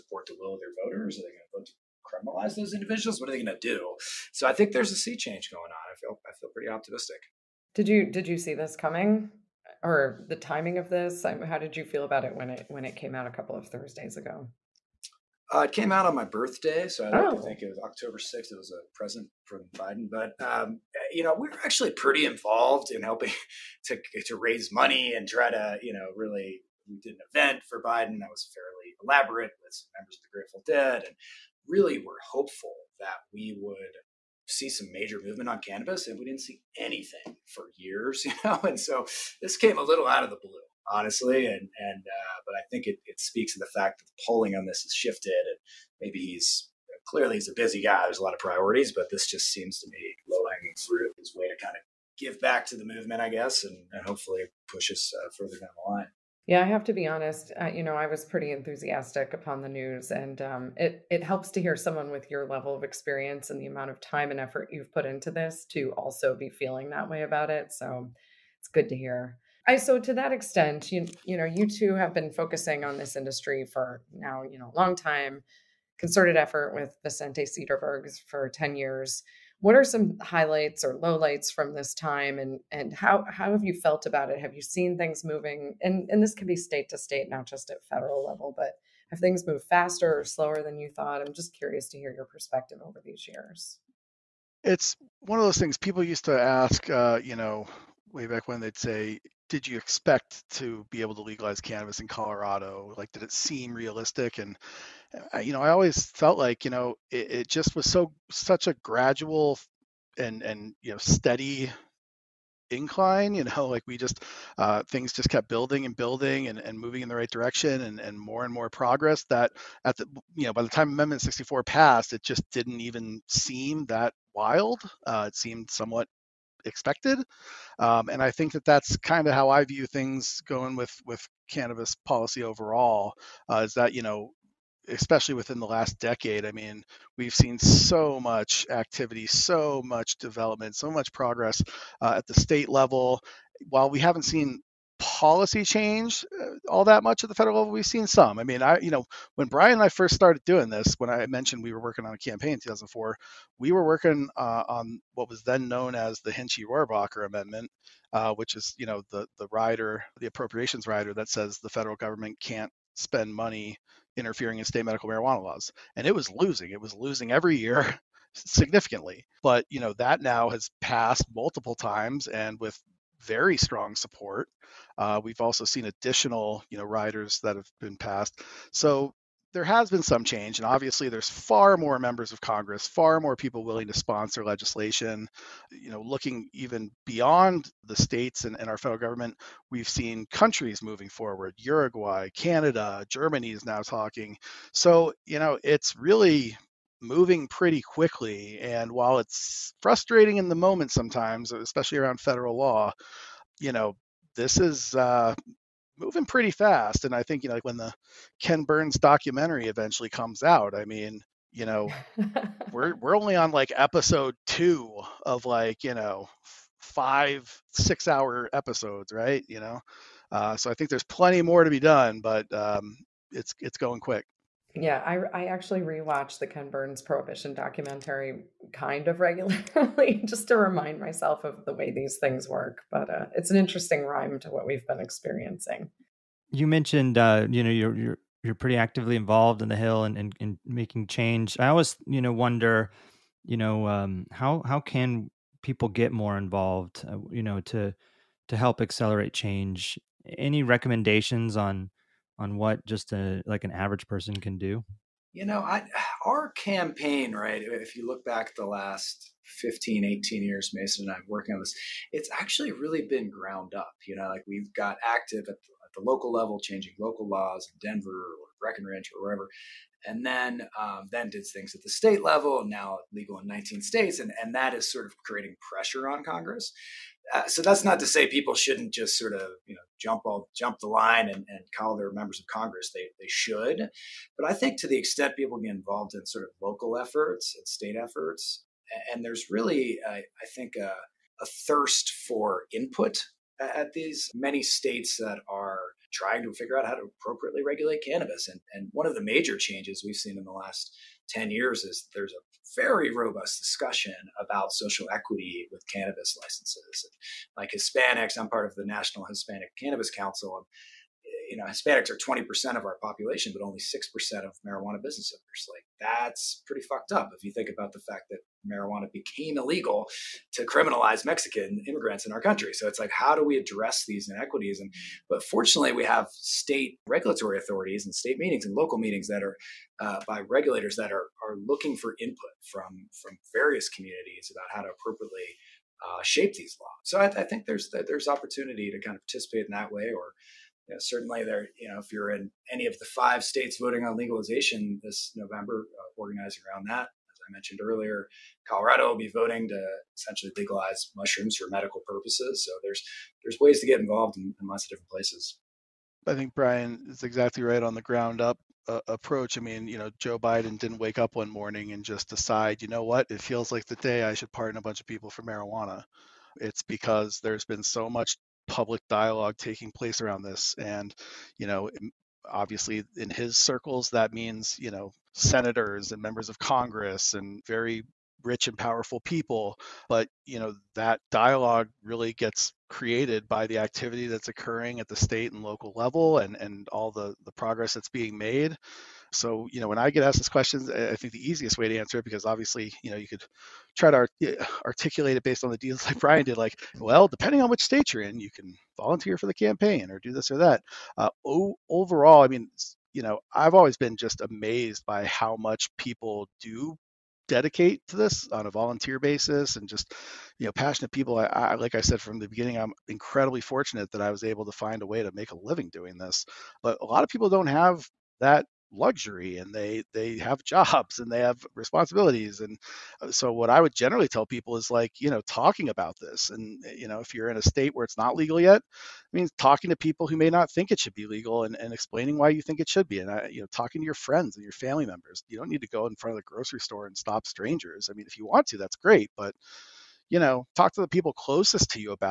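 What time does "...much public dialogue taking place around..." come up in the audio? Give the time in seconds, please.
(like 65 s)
368 s.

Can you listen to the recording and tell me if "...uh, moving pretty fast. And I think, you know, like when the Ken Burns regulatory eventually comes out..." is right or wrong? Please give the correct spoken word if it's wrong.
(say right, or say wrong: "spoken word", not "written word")
wrong: "documentary", not "regulatory".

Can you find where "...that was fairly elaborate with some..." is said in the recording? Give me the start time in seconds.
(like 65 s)
28 s.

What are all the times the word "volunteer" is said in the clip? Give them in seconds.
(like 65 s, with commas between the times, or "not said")
398 s, 408 s.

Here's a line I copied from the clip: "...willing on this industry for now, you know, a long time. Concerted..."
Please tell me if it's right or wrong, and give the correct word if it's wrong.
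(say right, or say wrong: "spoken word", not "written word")
wrong: "focusing", not "willing".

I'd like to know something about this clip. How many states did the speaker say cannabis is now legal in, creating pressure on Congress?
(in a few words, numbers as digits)
19.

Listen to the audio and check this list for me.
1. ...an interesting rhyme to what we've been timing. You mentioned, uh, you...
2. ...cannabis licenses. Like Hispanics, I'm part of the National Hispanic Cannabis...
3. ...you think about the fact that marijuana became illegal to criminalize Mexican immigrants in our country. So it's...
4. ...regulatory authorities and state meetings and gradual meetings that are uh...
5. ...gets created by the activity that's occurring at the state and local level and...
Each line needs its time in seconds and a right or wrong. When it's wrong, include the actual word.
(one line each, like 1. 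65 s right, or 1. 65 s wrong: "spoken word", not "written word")
1. 233 s wrong: "experiencing", not "timing"
2. 305 s right
3. 317 s right
4. 327 s wrong: "local", not "gradual"
5. 382 s right.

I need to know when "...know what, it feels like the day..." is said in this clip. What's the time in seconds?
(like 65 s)
362 s.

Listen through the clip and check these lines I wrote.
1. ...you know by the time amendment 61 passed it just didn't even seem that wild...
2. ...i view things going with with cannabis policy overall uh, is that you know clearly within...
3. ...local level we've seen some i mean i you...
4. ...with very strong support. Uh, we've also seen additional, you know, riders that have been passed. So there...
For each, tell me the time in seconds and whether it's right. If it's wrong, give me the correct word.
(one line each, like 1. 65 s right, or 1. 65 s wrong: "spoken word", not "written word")
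1. 120 s wrong: "64", not "61"
2. 129 s wrong: "especially", not "clearly"
3. 147 s wrong: "federal", not "local"
4. 172 s right.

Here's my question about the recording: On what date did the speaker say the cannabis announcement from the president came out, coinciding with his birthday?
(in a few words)
October 6th.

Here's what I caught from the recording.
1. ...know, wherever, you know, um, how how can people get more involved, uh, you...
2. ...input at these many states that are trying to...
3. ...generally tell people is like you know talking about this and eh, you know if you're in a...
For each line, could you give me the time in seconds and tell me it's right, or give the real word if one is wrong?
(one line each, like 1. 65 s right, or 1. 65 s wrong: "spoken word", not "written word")
1. 242 s wrong: "wonder", not "wherever"
2. 292 s right
3. 423 s right.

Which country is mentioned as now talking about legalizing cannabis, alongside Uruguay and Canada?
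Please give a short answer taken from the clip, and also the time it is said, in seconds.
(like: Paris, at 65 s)
Germany, at 193 s.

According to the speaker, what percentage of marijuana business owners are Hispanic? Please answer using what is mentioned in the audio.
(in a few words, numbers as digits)
6%.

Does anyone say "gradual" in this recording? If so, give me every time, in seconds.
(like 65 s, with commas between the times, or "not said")
108 s.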